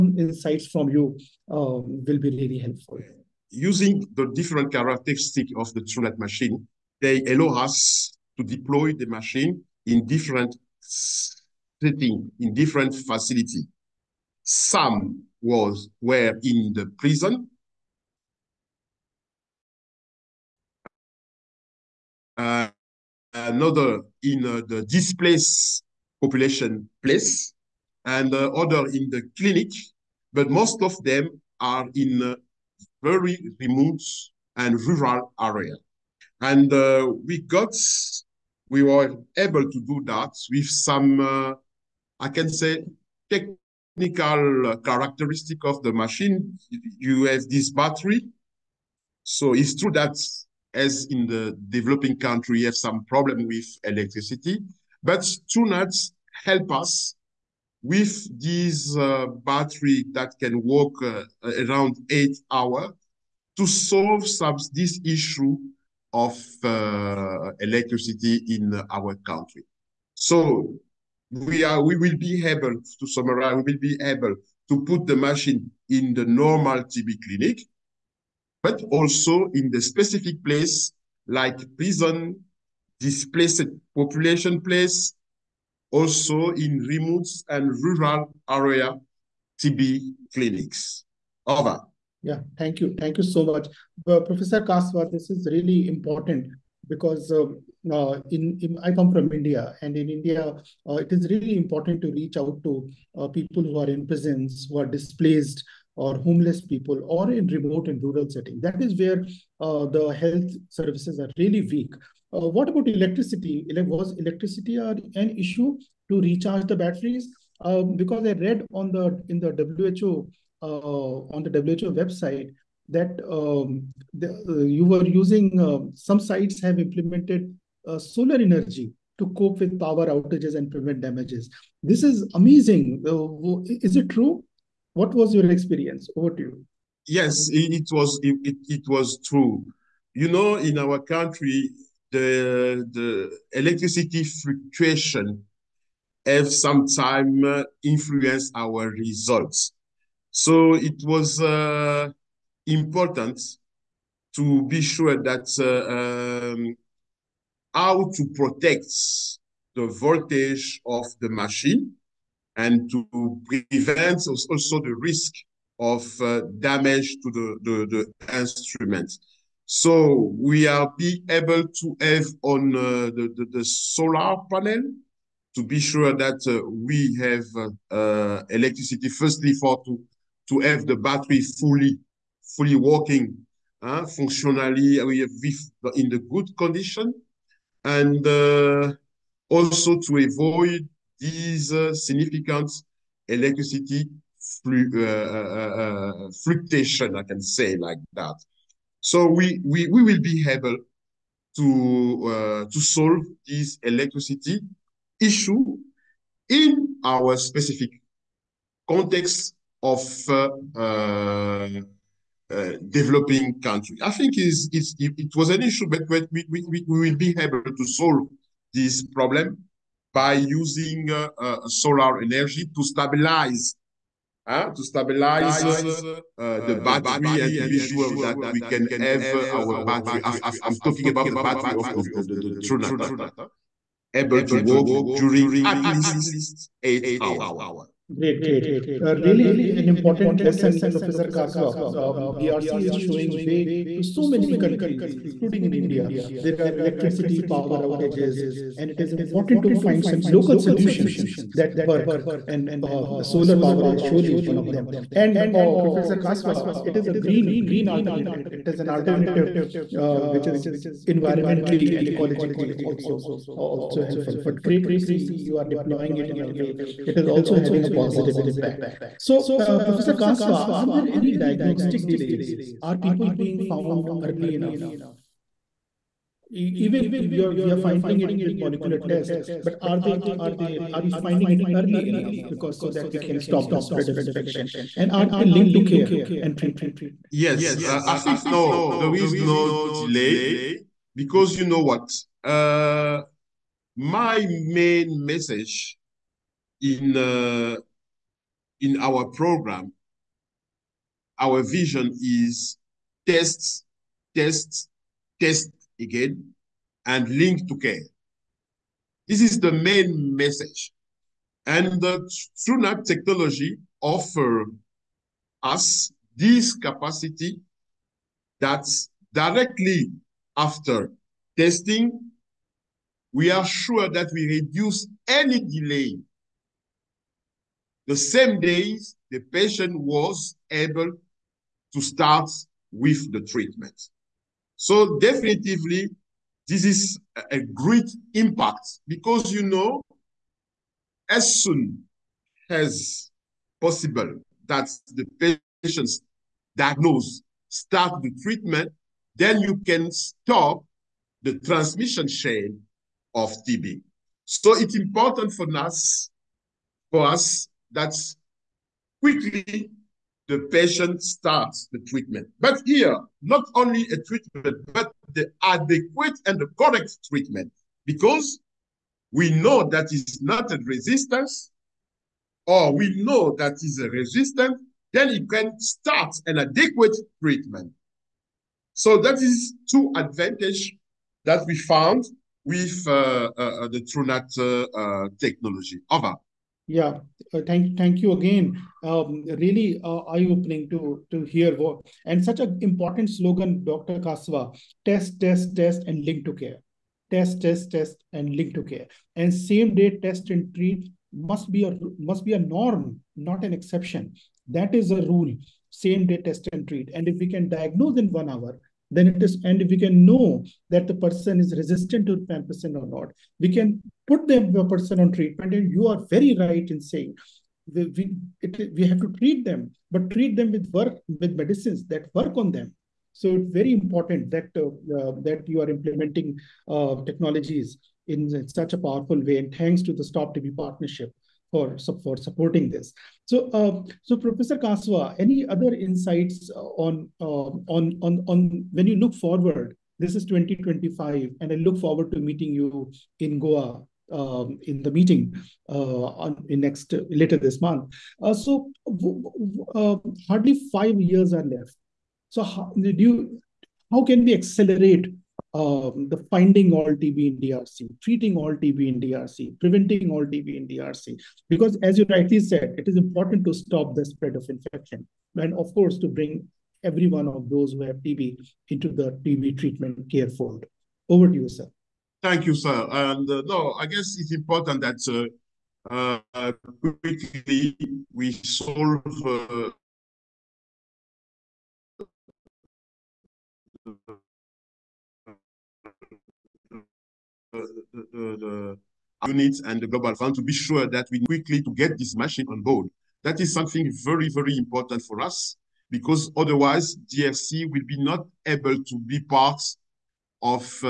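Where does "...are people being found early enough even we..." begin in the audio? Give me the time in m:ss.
4:32.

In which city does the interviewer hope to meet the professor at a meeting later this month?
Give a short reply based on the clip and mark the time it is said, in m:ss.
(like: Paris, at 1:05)
Goa, at 7:23.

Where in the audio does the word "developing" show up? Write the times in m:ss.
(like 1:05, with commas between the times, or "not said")
0:51, 3:32.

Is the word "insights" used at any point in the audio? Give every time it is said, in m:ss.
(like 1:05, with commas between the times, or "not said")
0:00, 7:15.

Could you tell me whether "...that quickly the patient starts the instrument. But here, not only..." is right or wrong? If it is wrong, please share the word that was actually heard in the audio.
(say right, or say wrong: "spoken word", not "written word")
wrong: "treatment", not "instrument".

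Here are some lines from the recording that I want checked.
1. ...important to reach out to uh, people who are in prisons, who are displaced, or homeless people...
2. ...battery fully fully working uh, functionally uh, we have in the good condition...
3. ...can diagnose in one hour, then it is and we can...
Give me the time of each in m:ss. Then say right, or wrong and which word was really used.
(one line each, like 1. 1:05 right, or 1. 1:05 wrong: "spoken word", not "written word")
1. 1:41 right
2. 3:00 right
3. 6:47 right.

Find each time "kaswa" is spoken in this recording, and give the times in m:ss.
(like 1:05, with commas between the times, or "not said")
1:34, 4:01, 4:16, 4:30, 6:34, 7:14.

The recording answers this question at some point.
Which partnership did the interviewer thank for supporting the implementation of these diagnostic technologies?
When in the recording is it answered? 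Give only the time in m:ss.
7:10.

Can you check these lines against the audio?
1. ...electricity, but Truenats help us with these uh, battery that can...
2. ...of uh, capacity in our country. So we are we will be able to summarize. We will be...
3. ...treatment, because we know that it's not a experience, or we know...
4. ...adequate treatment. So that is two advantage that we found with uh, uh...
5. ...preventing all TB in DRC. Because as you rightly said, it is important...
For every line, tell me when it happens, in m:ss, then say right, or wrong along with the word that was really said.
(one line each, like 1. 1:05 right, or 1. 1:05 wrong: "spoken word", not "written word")
1. 0:53 right
2. 1:06 wrong: "electricity", not "capacity"
3. 6:07 wrong: "resistance", not "experience"
4. 6:16 right
5. 7:39 right.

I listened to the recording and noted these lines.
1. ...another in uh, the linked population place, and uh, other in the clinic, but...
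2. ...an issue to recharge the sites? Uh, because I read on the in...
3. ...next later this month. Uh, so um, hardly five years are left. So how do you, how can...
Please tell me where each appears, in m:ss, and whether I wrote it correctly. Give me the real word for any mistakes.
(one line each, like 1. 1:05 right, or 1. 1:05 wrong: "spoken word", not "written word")
1. 0:23 wrong: "displaced", not "linked"
2. 1:54 wrong: "batteries", not "sites"
3. 7:26 right.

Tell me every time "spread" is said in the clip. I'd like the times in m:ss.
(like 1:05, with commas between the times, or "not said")
4:43, 7:44.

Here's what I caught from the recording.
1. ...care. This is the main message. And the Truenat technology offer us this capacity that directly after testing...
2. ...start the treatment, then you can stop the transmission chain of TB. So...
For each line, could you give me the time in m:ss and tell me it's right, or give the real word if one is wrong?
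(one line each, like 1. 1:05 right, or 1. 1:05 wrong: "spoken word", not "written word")
1. 5:07 right
2. 5:47 right.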